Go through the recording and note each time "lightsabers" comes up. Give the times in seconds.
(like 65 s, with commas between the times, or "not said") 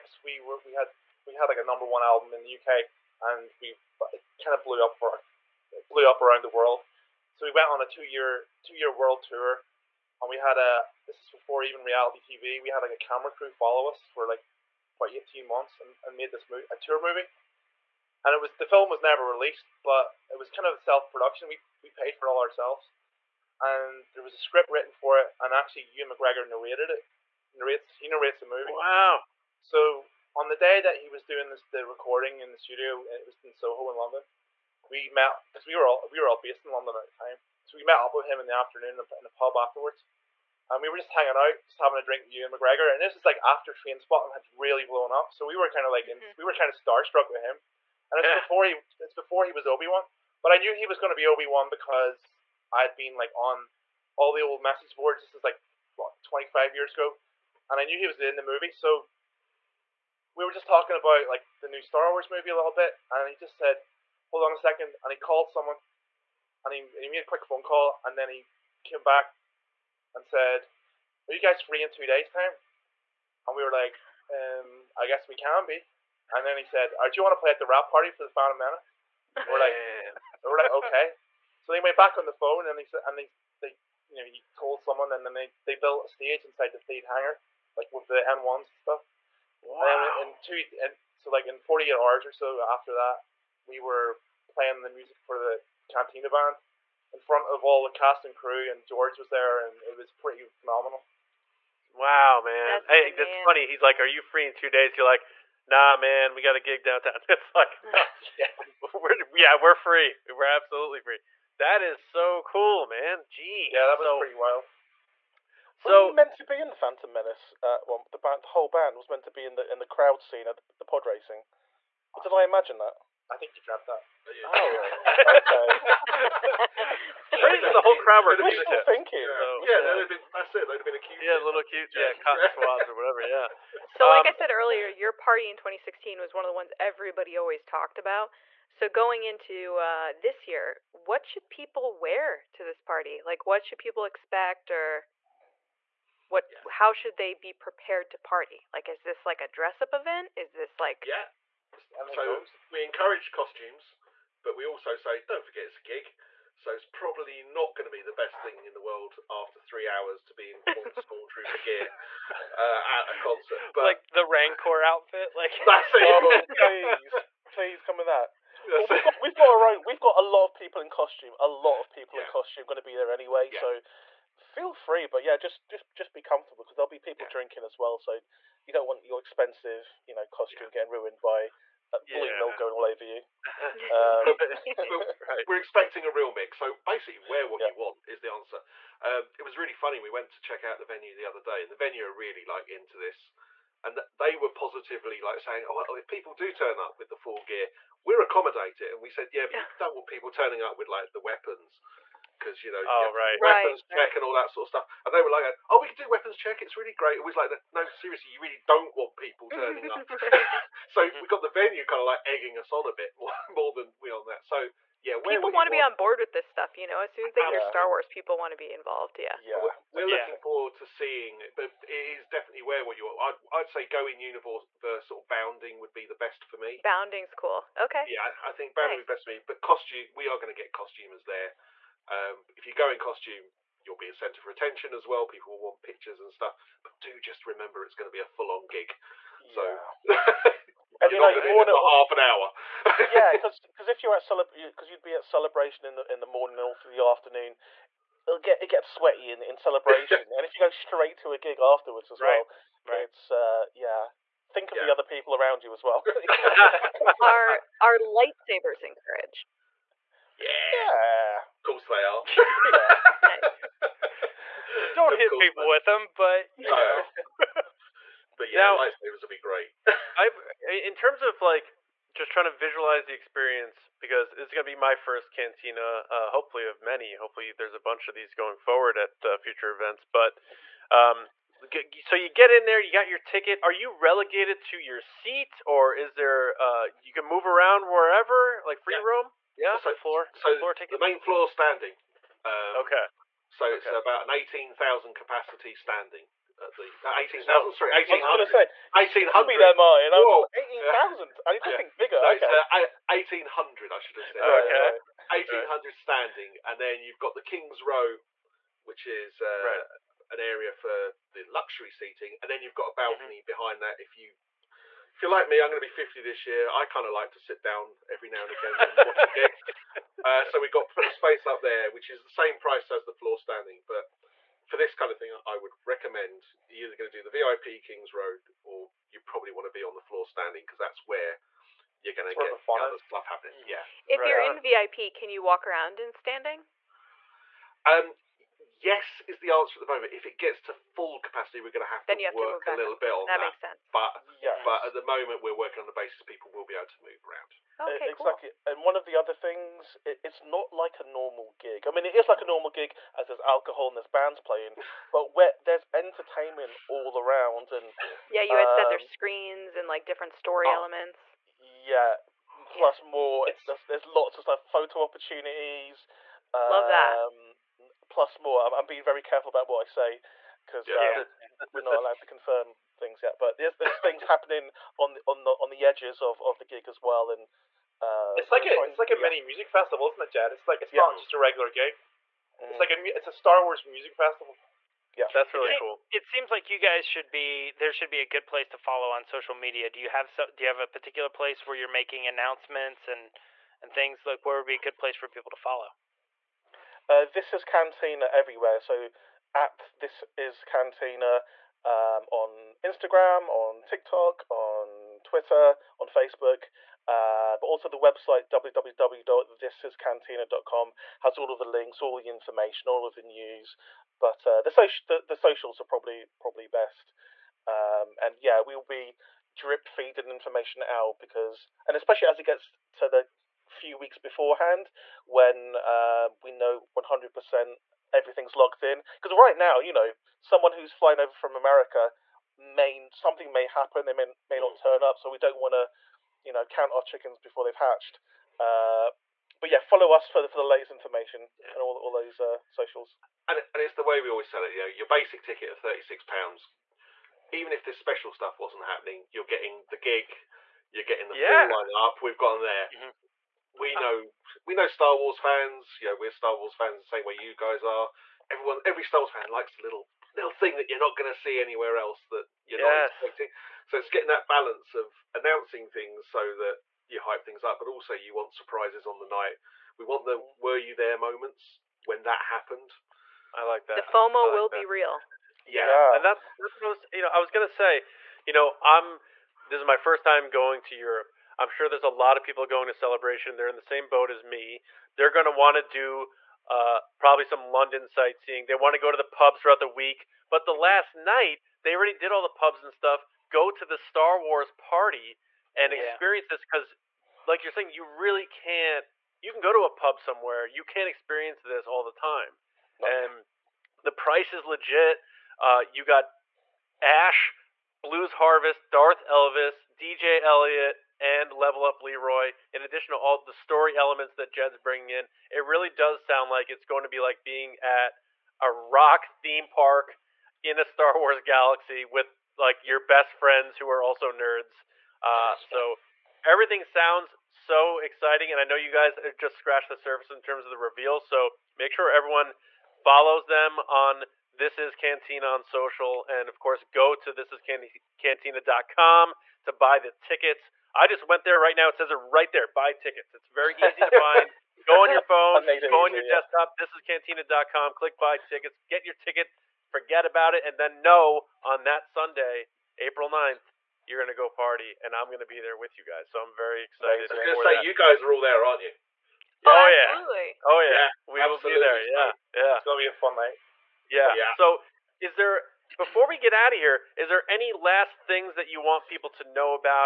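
257 s, 268 s.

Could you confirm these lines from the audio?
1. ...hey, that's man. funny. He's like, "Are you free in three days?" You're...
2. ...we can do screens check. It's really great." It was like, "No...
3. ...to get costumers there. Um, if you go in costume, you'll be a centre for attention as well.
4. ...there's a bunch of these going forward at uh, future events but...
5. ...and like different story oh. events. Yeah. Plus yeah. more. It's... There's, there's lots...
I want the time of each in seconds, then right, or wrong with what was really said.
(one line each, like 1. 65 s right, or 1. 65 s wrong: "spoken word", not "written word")
1. 102 s wrong: "two", not "three"
2. 205 s wrong: "weapons", not "screens"
3. 230 s right
4. 277 s right
5. 359 s wrong: "elements", not "events".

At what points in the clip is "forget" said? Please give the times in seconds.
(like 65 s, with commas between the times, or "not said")
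155 s, 549 s.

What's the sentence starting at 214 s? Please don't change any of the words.
So yeah, people want to be on board with this stuff.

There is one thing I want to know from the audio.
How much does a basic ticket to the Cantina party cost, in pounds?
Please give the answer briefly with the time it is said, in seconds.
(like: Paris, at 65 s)
36, at 445 s.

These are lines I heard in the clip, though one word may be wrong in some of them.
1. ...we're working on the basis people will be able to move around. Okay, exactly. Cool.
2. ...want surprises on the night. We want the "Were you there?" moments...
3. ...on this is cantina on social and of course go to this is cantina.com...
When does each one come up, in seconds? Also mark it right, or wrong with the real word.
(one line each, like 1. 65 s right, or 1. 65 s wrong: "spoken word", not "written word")
1. 345 s right
2. 468 s right
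3. 533 s right.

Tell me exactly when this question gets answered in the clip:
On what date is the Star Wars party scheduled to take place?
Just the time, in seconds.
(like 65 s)
552 s.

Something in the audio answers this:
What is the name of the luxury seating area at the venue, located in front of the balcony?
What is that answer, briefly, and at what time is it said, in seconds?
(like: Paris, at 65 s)
King's Row, at 307 s.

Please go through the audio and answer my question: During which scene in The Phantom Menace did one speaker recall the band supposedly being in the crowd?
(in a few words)
pod racing.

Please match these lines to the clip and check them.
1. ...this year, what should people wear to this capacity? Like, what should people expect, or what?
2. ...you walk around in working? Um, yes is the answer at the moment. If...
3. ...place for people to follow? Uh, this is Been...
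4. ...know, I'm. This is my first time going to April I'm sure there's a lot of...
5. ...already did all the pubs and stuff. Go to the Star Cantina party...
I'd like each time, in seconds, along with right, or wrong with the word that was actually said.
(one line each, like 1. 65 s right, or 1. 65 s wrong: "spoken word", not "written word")
1. 140 s wrong: "party", not "capacity"
2. 335 s wrong: "standing", not "working"
3. 394 s wrong: "Cantina", not "Been"
4. 478 s wrong: "Europe", not "April"
5. 491 s wrong: "Wars", not "Cantina".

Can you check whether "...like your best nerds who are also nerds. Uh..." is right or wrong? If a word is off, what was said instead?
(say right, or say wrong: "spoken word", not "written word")
wrong: "friends", not "nerds".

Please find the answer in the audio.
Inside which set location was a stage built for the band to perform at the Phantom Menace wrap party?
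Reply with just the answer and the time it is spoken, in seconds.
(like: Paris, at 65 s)
Theed hangar, at 86 s.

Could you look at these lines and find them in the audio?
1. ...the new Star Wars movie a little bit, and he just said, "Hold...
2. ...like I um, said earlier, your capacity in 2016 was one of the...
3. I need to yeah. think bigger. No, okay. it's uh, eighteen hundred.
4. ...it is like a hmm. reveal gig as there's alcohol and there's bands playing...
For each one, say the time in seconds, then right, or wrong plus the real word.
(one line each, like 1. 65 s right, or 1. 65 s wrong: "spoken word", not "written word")
1. 61 s right
2. 134 s wrong: "party", not "capacity"
3. 301 s right
4. 352 s wrong: "normal", not "reveal".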